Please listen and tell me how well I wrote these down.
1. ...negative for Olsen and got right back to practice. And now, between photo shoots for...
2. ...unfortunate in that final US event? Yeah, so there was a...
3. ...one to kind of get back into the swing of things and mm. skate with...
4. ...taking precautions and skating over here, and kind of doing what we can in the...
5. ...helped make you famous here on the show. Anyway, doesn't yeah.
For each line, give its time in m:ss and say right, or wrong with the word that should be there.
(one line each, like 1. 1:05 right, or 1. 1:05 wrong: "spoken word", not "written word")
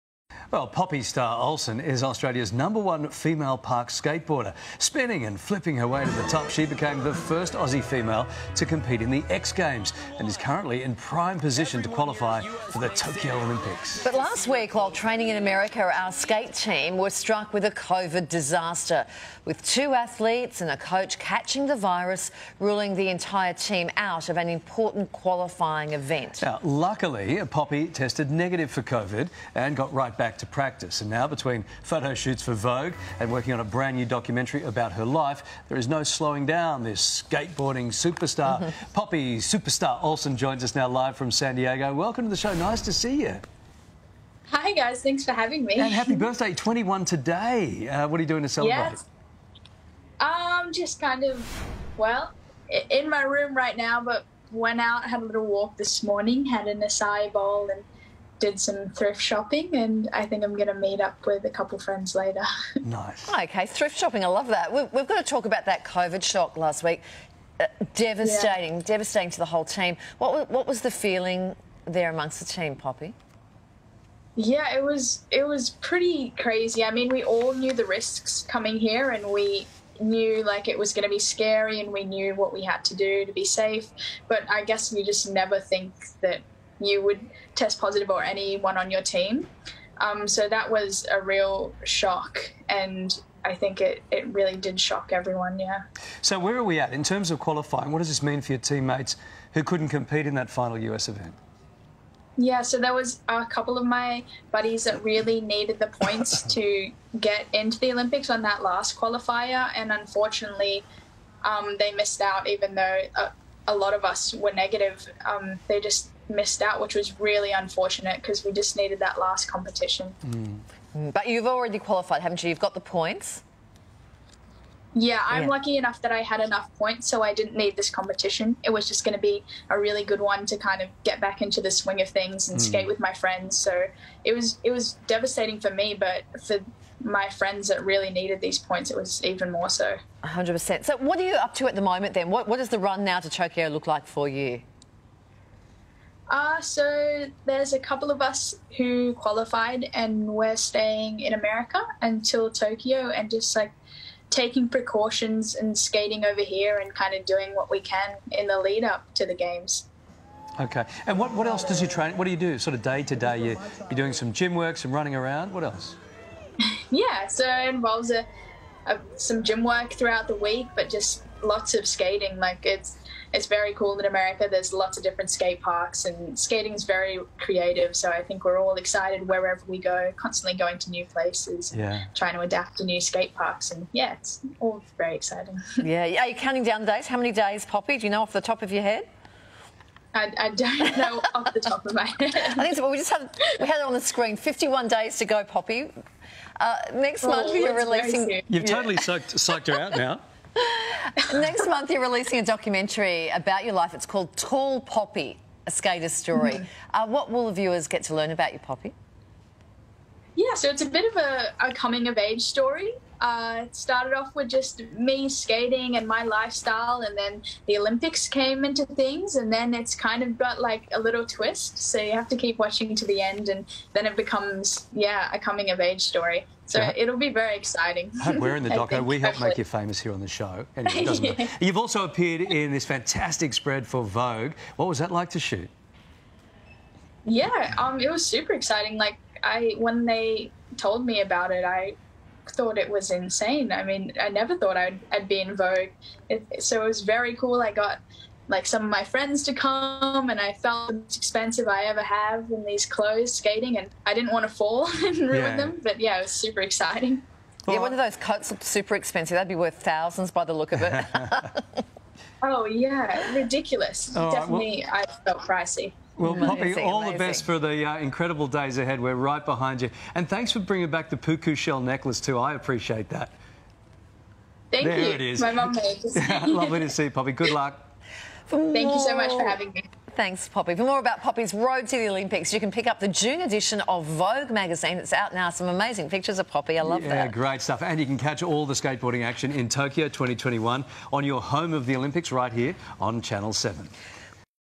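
1. 0:28 wrong: "COVID", not "Olsen"
2. 1:39 wrong: "compete", not "unfortunate"
3. 2:10 right
4. 2:34 right
5. 3:49 right.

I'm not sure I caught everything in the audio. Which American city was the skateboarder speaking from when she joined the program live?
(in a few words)
San Diego.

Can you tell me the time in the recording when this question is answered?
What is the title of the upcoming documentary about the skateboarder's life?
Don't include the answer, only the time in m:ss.
3:24.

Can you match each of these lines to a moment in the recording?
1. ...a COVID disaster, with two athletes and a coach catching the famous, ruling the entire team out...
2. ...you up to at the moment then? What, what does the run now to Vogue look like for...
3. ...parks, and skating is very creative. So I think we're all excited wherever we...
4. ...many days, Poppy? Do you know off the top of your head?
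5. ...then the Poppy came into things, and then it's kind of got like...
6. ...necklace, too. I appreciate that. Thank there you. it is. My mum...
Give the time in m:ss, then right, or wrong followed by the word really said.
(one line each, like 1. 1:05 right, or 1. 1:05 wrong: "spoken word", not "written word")
1. 0:17 wrong: "virus", not "famous"
2. 2:21 wrong: "Tokyo", not "Vogue"
3. 2:55 right
4. 3:07 right
5. 3:37 wrong: "Olympics", not "Poppy"
6. 4:31 right.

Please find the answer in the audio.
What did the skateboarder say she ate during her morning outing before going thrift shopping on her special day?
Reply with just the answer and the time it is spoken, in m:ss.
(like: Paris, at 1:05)
acai bowl, at 0:56.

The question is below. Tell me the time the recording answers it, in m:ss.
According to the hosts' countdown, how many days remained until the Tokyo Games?
3:14.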